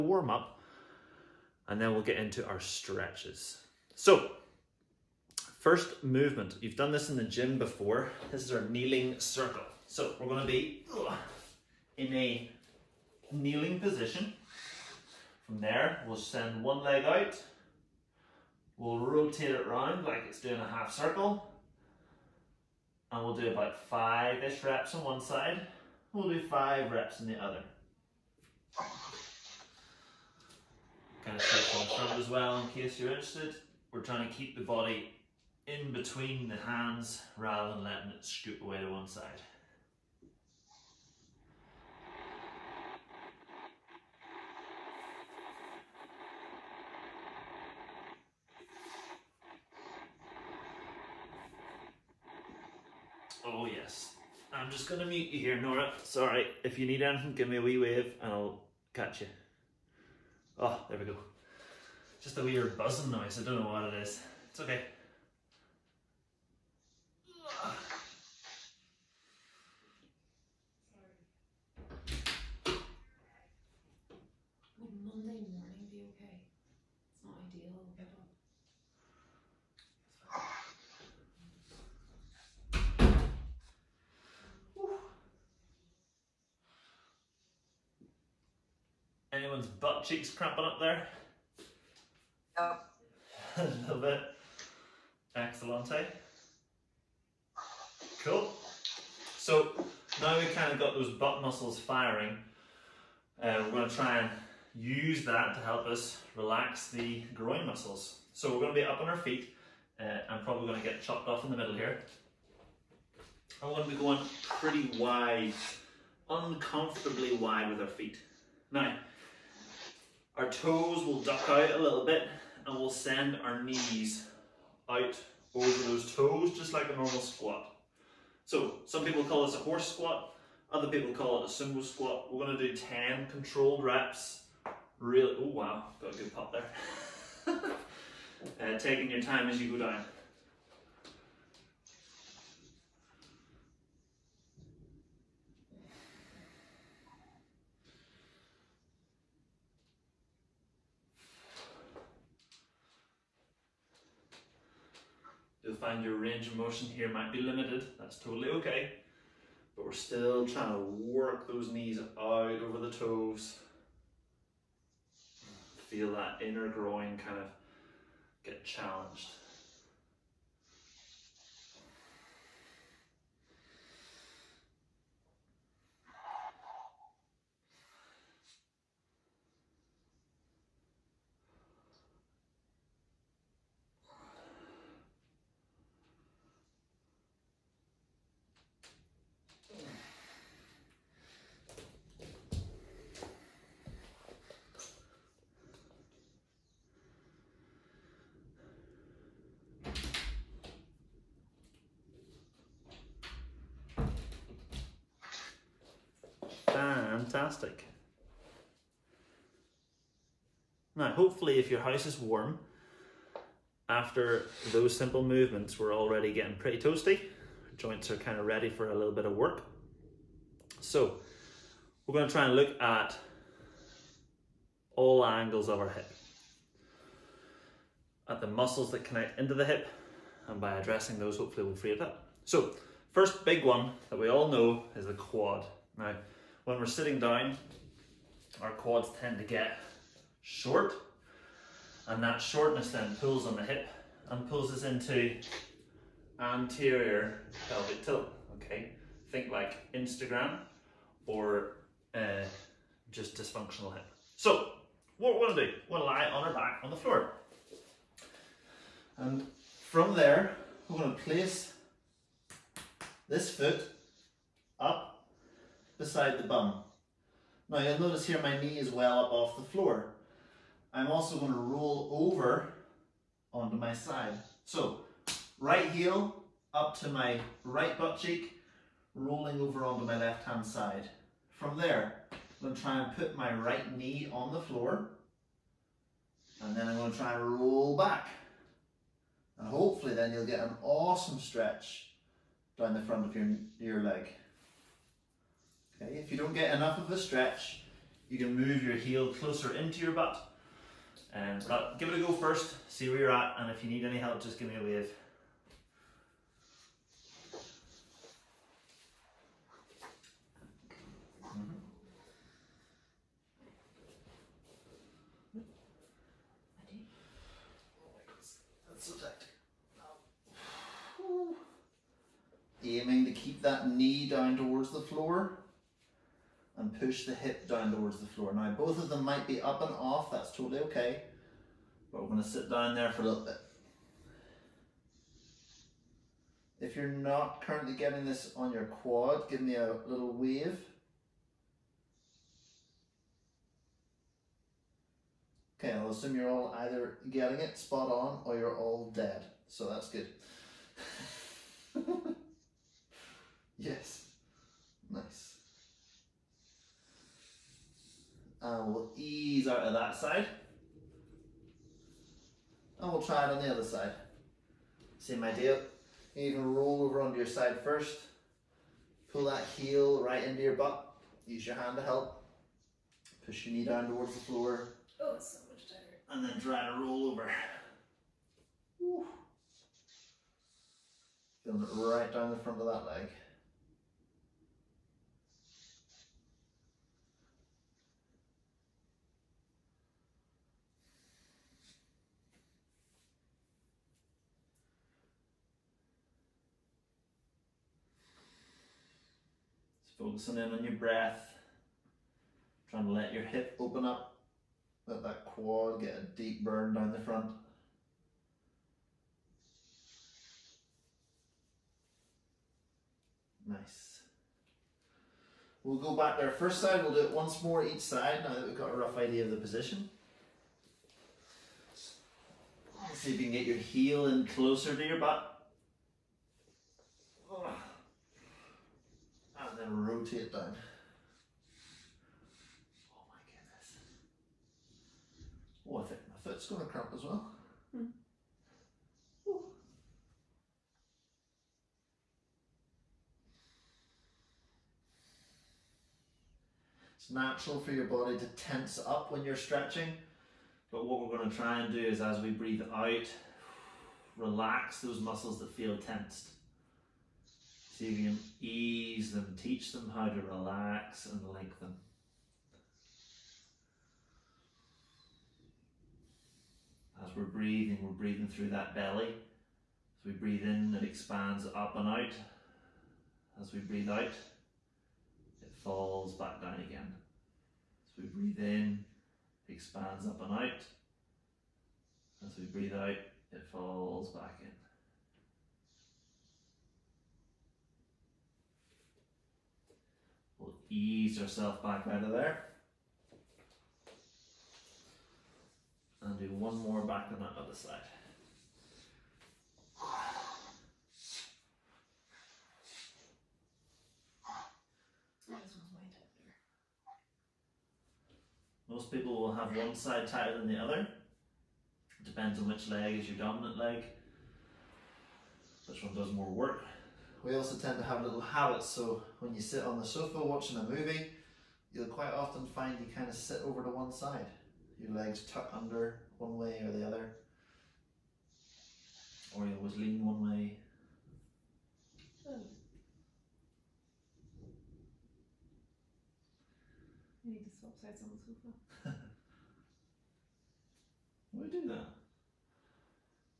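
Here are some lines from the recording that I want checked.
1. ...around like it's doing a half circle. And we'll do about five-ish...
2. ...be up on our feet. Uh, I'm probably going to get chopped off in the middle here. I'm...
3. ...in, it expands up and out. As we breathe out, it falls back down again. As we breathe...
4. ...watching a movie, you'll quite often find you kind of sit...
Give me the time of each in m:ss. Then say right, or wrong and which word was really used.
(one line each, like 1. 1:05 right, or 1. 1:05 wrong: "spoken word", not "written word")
1. 0:19 right
2. 1:48 right
3. 7:50 right
4. 8:40 right.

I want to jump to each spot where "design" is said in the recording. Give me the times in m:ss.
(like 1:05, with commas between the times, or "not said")
not said.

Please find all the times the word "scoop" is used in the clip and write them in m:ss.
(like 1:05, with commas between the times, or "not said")
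0:38.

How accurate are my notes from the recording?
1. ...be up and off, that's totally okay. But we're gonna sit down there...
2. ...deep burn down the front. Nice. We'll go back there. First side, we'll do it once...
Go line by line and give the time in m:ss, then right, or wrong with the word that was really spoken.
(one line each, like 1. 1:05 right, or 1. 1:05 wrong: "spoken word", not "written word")
1. 5:29 right
2. 6:46 right.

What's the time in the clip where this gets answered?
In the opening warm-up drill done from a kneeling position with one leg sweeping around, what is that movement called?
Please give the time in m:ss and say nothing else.
0:08.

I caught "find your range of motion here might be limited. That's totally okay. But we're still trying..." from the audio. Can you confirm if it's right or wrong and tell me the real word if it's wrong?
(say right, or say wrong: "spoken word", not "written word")
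right.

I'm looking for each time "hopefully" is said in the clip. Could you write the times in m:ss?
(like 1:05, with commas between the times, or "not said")
3:31, 3:51, 4:49.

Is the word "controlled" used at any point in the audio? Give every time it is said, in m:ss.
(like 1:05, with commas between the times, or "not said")
2:13.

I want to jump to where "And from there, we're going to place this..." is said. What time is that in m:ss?
4:19.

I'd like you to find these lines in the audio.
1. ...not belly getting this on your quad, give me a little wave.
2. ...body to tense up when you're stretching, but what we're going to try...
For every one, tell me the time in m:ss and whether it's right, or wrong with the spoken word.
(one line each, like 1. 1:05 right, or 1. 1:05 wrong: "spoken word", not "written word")
1. 5:37 wrong: "currently", not "belly"
2. 7:28 right.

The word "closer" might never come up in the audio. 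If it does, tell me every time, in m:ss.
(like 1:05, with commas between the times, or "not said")
4:59, 7:04.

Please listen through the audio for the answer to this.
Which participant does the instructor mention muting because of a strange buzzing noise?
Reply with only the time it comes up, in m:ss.
0:55.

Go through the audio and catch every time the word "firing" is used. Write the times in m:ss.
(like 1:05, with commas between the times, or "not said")
1:41.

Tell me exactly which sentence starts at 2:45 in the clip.
Feel that inner groin kind of get challenged.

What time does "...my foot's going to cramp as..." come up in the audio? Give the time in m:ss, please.
7:16.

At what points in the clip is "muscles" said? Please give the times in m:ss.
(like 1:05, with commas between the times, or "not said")
1:41, 1:47, 3:48, 7:35.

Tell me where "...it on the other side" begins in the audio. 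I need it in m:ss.
6:03.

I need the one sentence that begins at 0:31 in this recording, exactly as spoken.
Kind of take front as well in case you're interested.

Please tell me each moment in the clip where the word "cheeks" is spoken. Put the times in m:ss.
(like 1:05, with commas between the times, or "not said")
1:30, 4:38.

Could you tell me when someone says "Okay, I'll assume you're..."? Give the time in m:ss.
5:45.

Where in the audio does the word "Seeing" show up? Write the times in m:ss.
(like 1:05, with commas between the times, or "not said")
7:38.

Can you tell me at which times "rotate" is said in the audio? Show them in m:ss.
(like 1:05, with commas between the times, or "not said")
0:18, 7:10.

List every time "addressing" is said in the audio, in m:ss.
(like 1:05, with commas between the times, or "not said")
3:50.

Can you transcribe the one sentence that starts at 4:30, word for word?
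I'm also going to roll over onto my side.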